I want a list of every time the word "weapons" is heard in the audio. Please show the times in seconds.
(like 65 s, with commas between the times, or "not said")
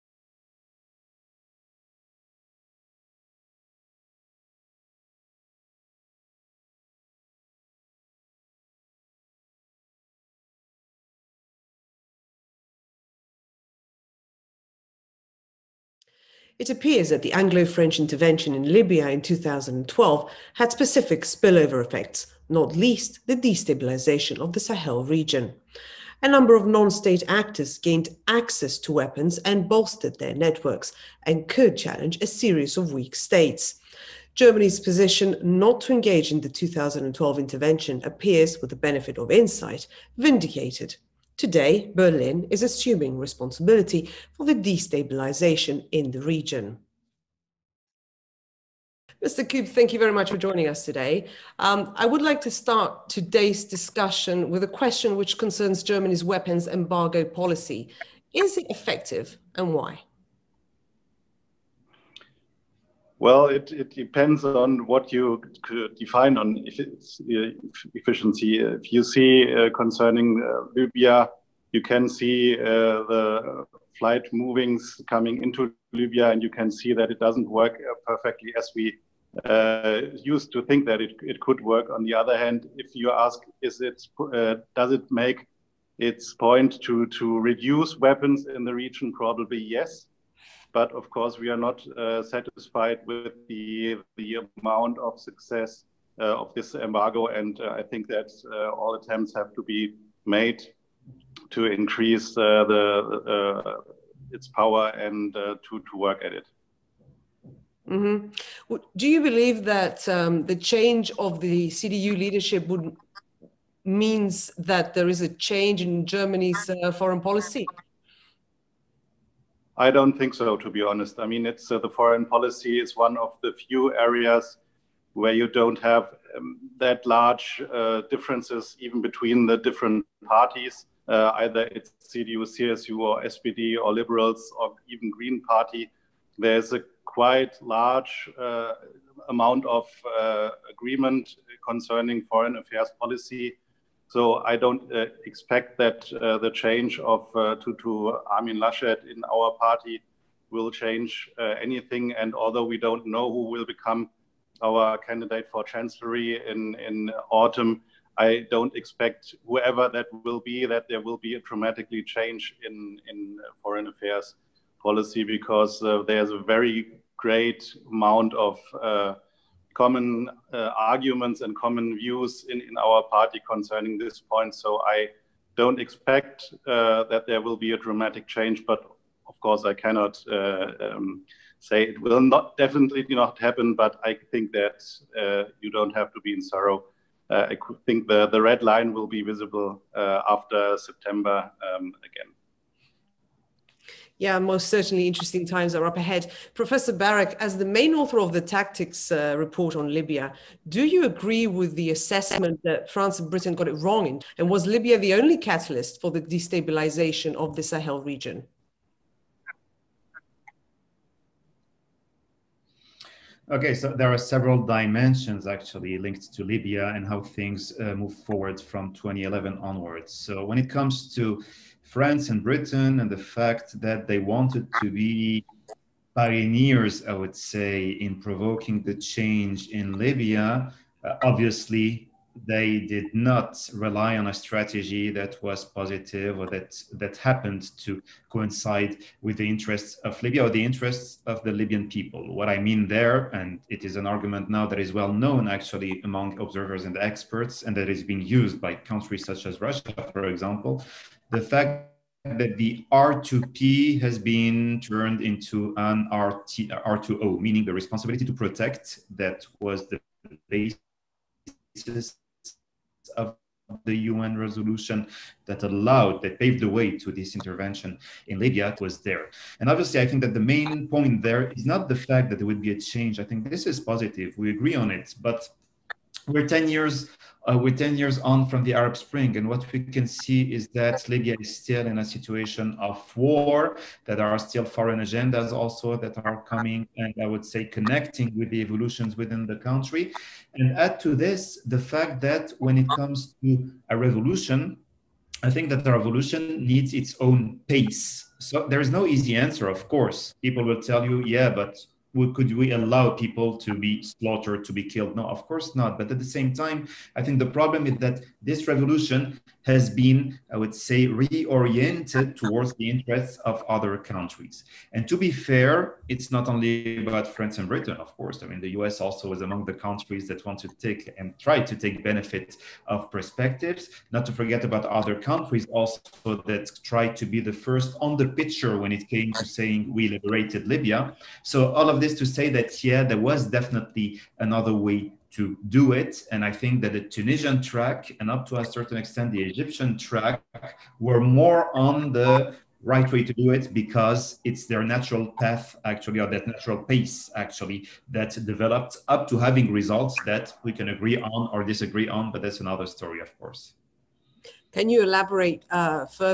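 28 s, 56 s, 87 s.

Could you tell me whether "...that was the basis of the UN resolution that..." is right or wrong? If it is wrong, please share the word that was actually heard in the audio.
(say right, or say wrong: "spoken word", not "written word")
right.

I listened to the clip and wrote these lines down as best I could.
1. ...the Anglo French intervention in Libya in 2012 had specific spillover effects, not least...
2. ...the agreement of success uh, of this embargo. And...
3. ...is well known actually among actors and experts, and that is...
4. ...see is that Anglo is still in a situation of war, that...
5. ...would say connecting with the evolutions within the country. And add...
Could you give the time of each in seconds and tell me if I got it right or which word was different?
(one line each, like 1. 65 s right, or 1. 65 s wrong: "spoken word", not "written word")
1. 17 s right
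2. 94 s wrong: "amount", not "agreement"
3. 244 s wrong: "observers", not "actors"
4. 280 s wrong: "Libya", not "Anglo"
5. 287 s right.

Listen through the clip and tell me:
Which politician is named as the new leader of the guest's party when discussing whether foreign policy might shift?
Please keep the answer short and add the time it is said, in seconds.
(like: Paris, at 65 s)
Armin Laschet, at 148 s.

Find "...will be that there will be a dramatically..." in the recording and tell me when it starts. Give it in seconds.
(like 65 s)
160 s.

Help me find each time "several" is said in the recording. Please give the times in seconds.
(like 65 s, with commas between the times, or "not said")
214 s.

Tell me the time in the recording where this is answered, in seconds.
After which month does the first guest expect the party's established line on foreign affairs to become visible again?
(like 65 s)
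190 s.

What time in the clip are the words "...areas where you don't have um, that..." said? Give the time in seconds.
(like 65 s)
123 s.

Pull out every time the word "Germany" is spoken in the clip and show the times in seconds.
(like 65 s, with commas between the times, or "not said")
34 s, 55 s, 116 s.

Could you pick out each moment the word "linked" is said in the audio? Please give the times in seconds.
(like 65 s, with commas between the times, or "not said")
215 s.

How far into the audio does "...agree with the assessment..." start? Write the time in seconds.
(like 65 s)
201 s.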